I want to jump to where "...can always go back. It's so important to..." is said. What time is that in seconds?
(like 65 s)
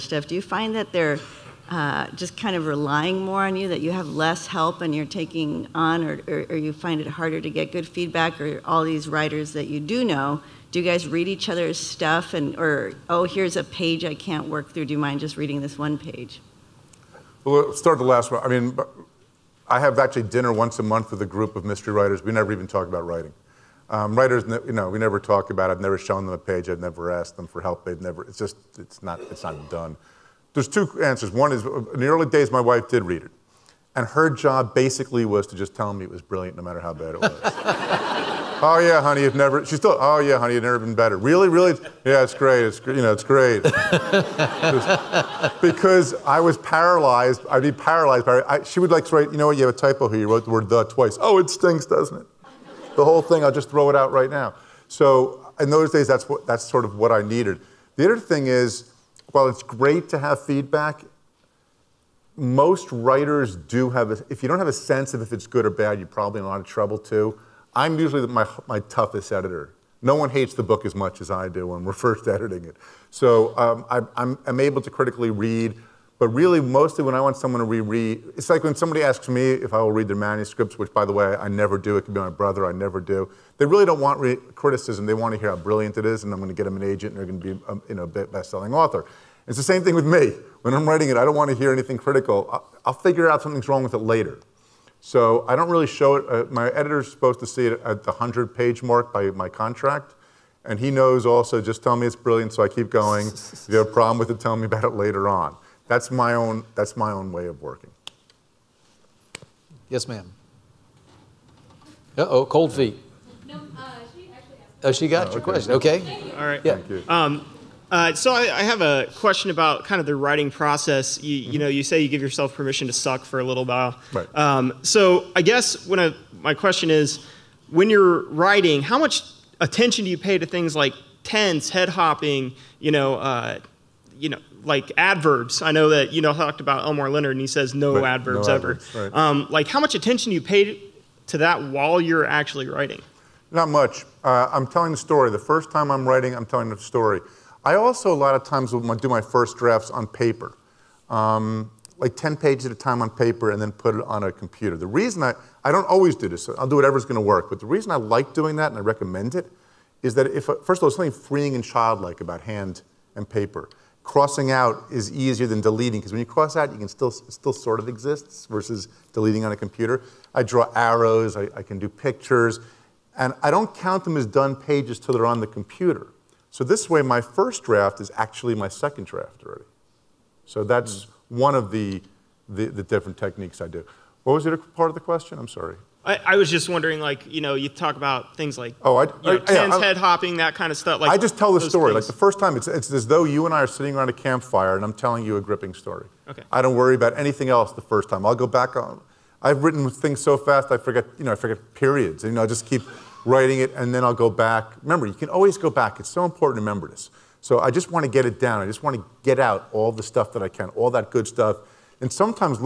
205 s.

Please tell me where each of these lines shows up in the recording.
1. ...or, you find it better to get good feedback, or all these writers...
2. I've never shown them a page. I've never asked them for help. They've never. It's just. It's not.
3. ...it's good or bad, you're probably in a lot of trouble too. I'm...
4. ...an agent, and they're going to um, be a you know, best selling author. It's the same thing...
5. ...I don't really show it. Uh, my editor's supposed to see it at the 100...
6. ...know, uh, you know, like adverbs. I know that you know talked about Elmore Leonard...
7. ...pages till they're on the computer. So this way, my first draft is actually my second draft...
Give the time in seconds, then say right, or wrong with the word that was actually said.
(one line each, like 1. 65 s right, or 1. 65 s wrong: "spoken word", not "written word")
1. 6 s wrong: "harder", not "better"
2. 25 s right
3. 65 s right
4. 86 s right
5. 95 s right
6. 132 s right
7. 174 s right.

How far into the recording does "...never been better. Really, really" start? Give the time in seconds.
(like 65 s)
40 s.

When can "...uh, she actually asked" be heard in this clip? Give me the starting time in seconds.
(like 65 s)
113 s.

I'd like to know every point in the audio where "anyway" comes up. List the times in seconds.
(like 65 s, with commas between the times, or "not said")
not said.